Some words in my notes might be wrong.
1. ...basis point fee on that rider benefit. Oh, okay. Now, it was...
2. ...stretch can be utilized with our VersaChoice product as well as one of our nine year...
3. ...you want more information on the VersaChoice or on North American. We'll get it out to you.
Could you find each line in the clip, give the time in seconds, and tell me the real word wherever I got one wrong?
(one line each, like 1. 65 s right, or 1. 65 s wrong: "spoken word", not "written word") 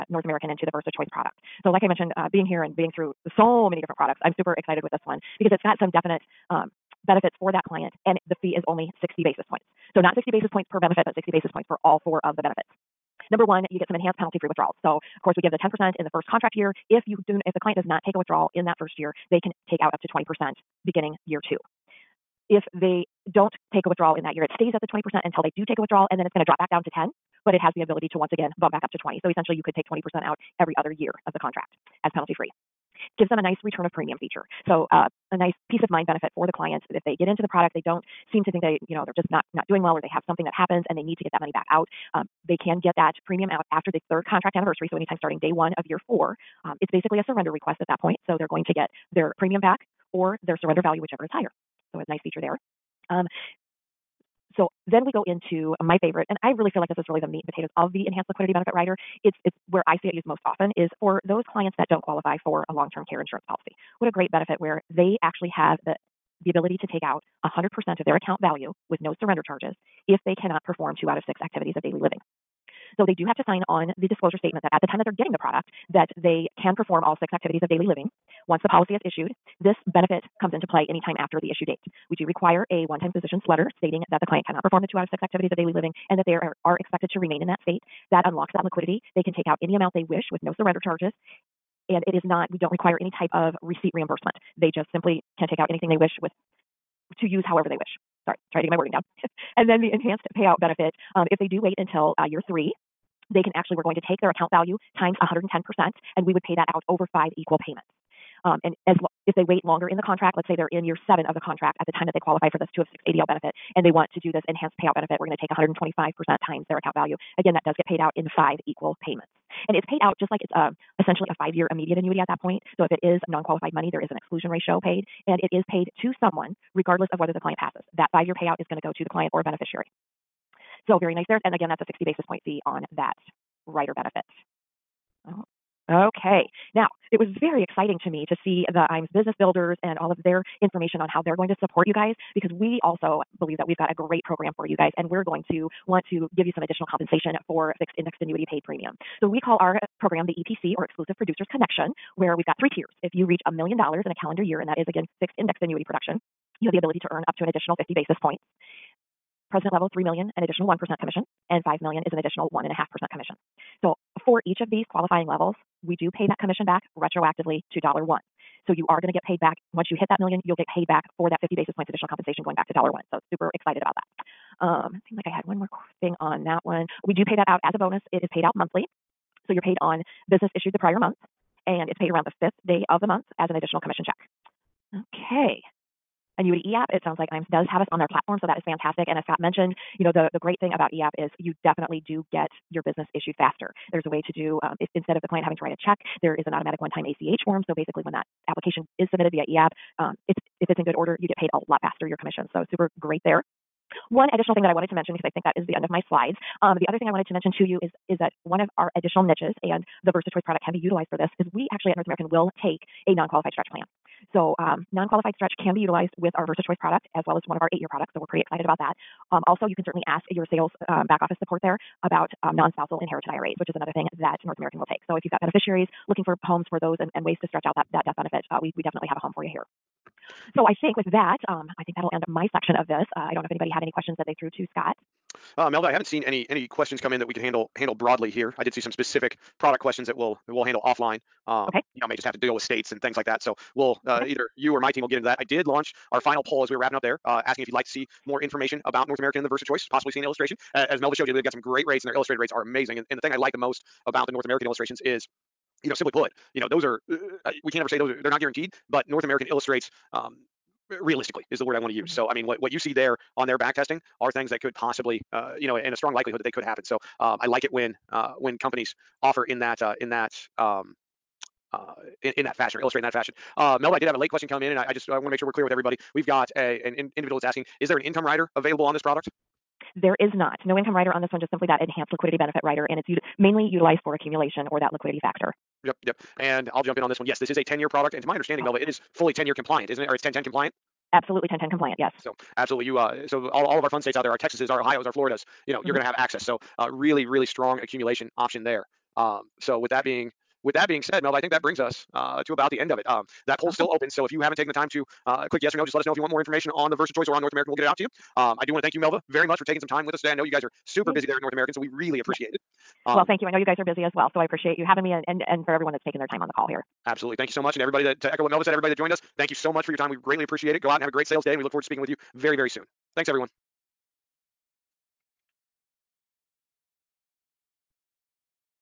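1. 132 s right
2. 215 s wrong: "eight", not "nine"
3. 306 s right.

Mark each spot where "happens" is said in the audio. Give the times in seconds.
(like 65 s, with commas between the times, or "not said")
40 s, 266 s.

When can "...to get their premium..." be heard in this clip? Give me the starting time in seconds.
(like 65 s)
48 s.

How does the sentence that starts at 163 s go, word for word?
So for each of these qualifying levels, we do pay that commission back retroactively to dollar one.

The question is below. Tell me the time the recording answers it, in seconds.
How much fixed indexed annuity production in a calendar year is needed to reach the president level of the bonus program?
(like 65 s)
159 s.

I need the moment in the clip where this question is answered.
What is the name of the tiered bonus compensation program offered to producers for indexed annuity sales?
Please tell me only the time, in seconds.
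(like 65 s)
150 s.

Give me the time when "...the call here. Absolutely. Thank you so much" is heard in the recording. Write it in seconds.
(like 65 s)
316 s.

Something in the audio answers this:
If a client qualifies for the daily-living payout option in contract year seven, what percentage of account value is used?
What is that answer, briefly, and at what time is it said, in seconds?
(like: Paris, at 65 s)
125%, at 115 s.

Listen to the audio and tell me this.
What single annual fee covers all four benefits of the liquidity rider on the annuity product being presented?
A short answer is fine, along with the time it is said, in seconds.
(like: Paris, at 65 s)
60 basis points, at 8 s.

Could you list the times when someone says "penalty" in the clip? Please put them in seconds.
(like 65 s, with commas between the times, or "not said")
14 s, 32 s.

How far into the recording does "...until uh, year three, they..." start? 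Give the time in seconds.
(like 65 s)
101 s.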